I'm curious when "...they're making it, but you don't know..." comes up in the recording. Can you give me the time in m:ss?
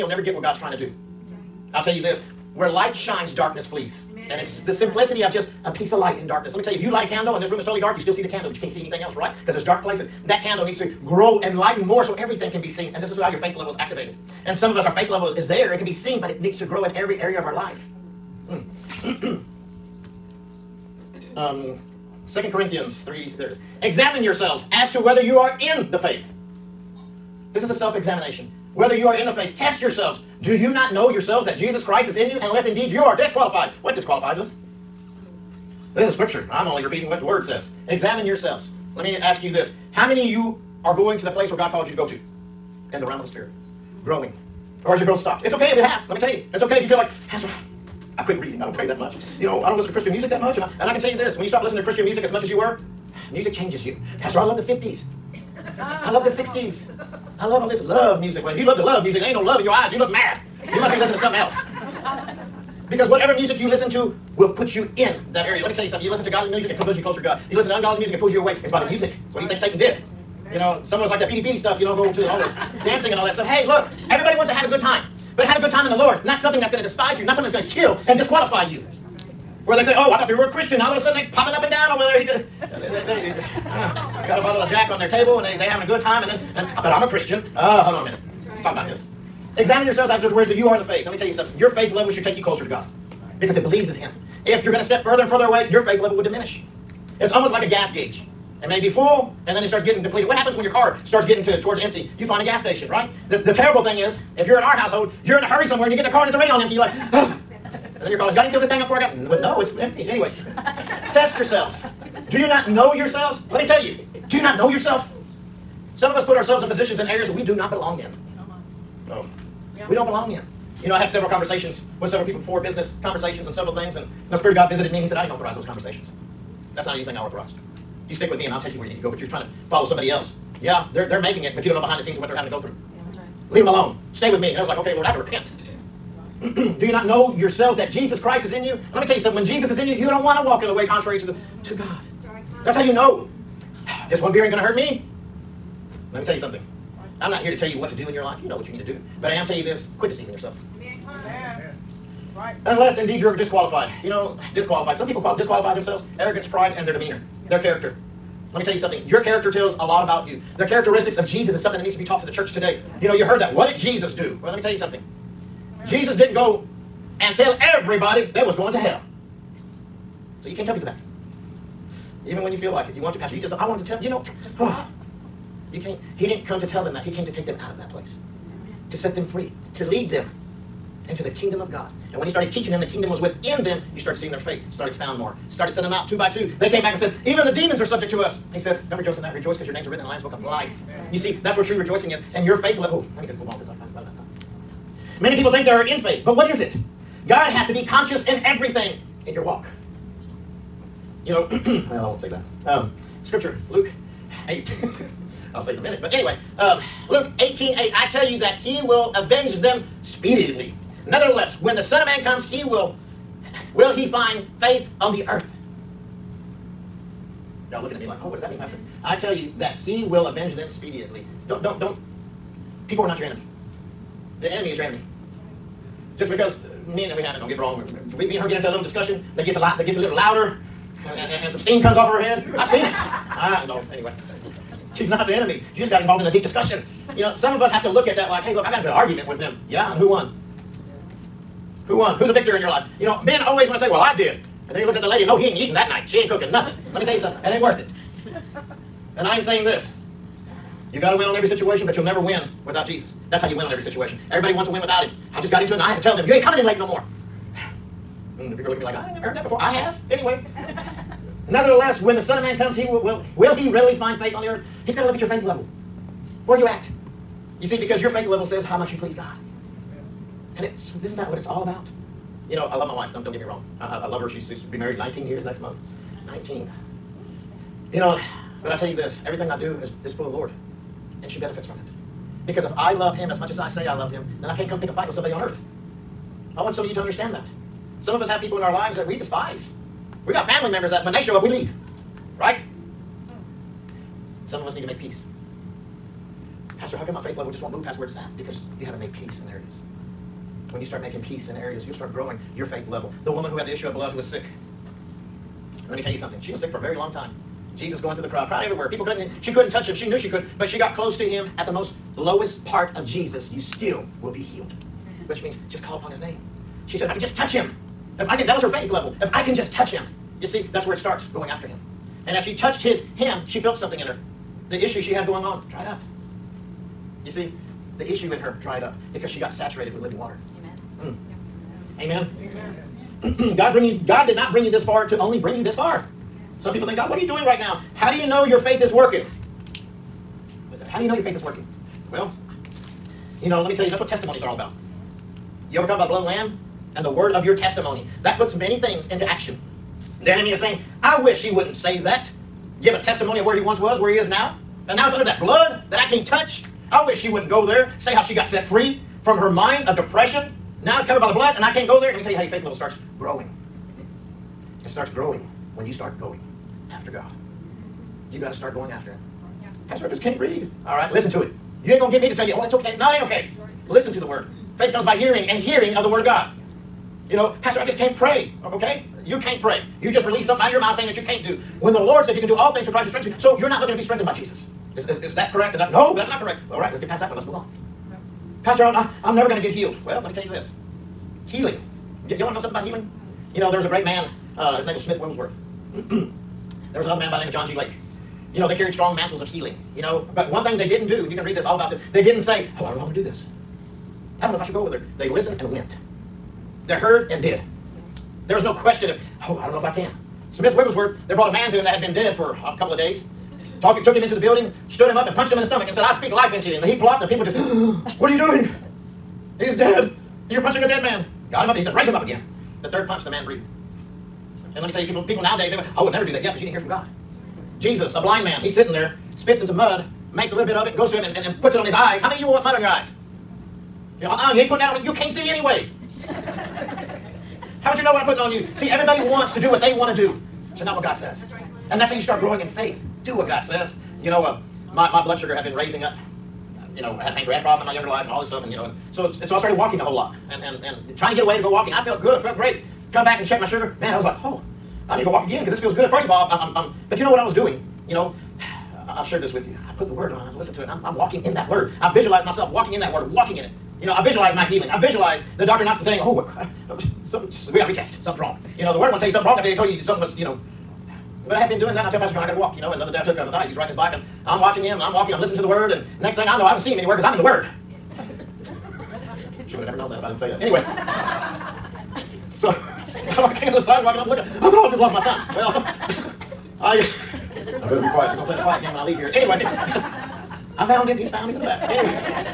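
2:11.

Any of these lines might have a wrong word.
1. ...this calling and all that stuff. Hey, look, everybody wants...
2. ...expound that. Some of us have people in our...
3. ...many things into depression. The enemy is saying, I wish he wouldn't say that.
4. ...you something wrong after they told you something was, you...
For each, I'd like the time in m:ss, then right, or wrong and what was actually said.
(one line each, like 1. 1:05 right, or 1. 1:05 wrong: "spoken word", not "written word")
1. 1:12 wrong: "dancing", not "calling"
2. 4:47 wrong: "understand", not "expound"
3. 5:48 wrong: "action", not "depression"
4. 7:49 right.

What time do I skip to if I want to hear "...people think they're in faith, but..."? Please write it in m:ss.
3:15.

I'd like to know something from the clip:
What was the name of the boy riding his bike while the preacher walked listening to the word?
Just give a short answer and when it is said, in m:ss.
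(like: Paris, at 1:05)
Matthias, at 7:53.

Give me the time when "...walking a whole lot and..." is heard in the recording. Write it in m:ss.
7:29.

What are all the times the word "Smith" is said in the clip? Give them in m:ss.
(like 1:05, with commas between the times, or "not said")
6:35, 6:50.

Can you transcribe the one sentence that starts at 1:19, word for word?
Where they say, oh, I thought they were a Christian.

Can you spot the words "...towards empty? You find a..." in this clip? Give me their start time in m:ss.
1:41.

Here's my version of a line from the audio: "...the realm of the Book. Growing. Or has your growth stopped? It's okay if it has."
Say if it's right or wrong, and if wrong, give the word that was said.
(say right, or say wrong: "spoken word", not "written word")
wrong: "Spirit", not "Book".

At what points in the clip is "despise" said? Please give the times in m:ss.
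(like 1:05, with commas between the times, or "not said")
1:16, 4:49.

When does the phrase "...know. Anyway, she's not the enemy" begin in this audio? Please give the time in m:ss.
3:53.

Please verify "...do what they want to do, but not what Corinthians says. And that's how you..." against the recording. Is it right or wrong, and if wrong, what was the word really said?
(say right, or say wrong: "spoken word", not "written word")
wrong: "God", not "Corinthians".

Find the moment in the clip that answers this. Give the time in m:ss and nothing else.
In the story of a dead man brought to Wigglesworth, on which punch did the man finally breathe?
7:02.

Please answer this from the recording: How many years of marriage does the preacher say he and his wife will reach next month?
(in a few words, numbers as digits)
19.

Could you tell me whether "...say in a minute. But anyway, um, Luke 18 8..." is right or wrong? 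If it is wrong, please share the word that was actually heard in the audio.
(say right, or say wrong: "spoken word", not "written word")
right.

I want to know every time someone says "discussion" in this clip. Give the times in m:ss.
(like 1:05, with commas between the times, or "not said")
3:48, 3:56.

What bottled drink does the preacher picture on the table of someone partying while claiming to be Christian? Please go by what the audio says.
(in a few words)
Jack.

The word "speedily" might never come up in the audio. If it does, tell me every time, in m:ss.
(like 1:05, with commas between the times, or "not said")
3:30, 3:40.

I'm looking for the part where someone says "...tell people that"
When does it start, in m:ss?
2:50.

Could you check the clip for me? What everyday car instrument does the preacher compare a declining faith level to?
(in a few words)
A gas gauge.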